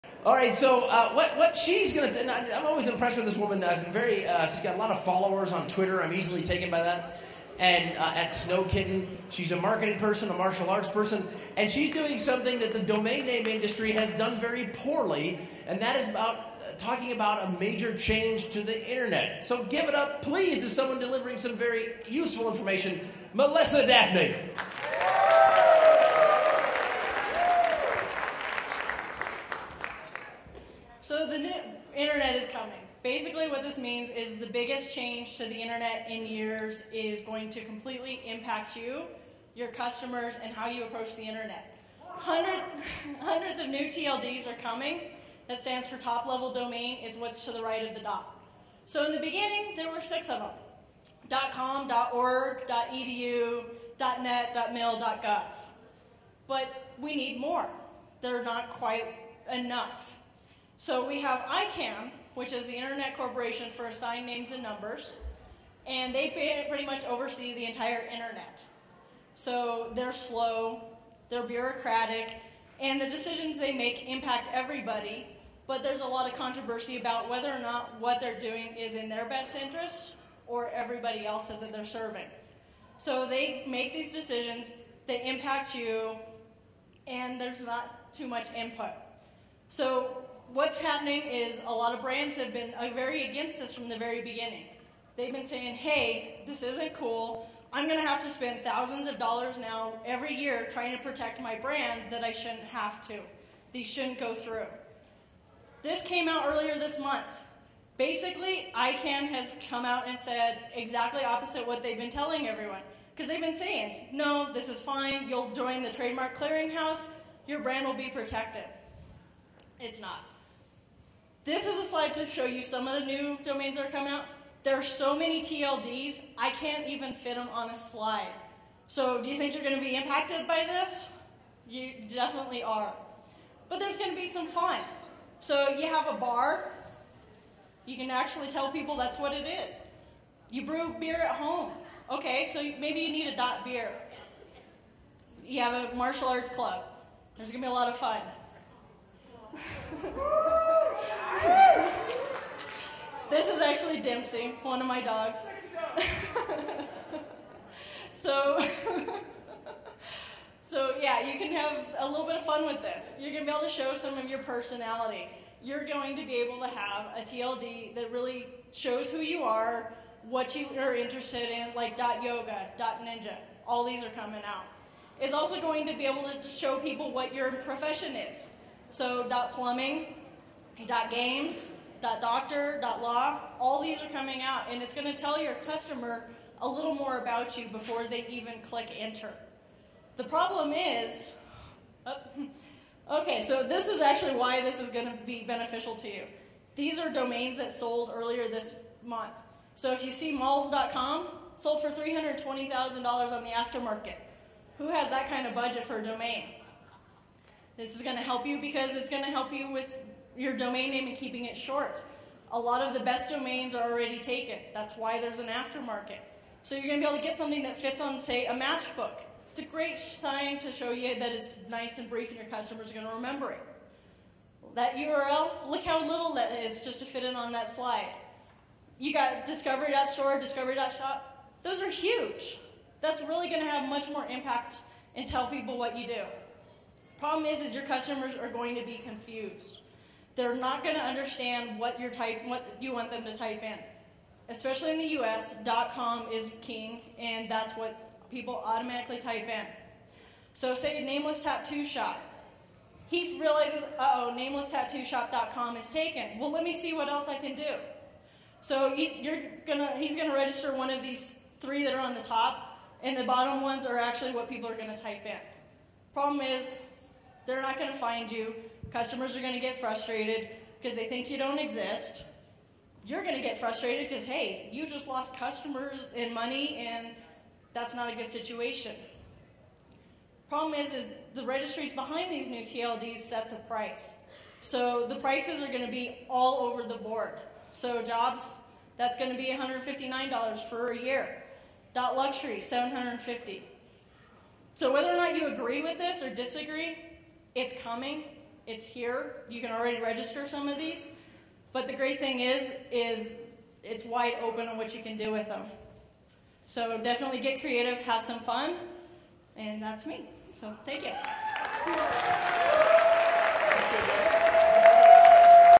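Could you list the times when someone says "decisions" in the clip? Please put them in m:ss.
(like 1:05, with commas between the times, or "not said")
1:13, 1:24.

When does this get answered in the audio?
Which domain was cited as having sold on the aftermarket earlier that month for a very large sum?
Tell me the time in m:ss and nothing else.
3:20.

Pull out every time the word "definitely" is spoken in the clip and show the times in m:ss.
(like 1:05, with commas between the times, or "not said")
2:12, 5:07.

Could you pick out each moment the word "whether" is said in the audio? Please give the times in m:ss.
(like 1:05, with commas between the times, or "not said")
1:17, 4:54.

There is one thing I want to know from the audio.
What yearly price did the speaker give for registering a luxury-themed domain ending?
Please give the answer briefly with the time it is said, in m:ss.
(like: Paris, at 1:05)
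$750, at 4:52.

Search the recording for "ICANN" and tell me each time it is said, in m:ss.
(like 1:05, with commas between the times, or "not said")
1:01, 1:48.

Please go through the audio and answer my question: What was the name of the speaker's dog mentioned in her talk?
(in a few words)
Dempsey.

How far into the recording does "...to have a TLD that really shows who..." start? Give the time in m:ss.
2:46.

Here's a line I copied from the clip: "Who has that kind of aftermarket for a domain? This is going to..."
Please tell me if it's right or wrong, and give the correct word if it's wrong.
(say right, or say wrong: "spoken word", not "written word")
wrong: "budget", not "aftermarket".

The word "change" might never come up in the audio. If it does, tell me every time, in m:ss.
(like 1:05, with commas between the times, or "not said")
0:17, 0:34.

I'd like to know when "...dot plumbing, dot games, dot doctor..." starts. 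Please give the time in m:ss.
2:59.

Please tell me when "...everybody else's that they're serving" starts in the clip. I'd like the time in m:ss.
1:20.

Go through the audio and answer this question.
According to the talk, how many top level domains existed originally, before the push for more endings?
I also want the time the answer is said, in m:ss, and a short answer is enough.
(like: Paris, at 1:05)
6, at 0:49.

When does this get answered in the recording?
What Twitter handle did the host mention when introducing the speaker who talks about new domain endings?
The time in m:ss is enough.
0:08.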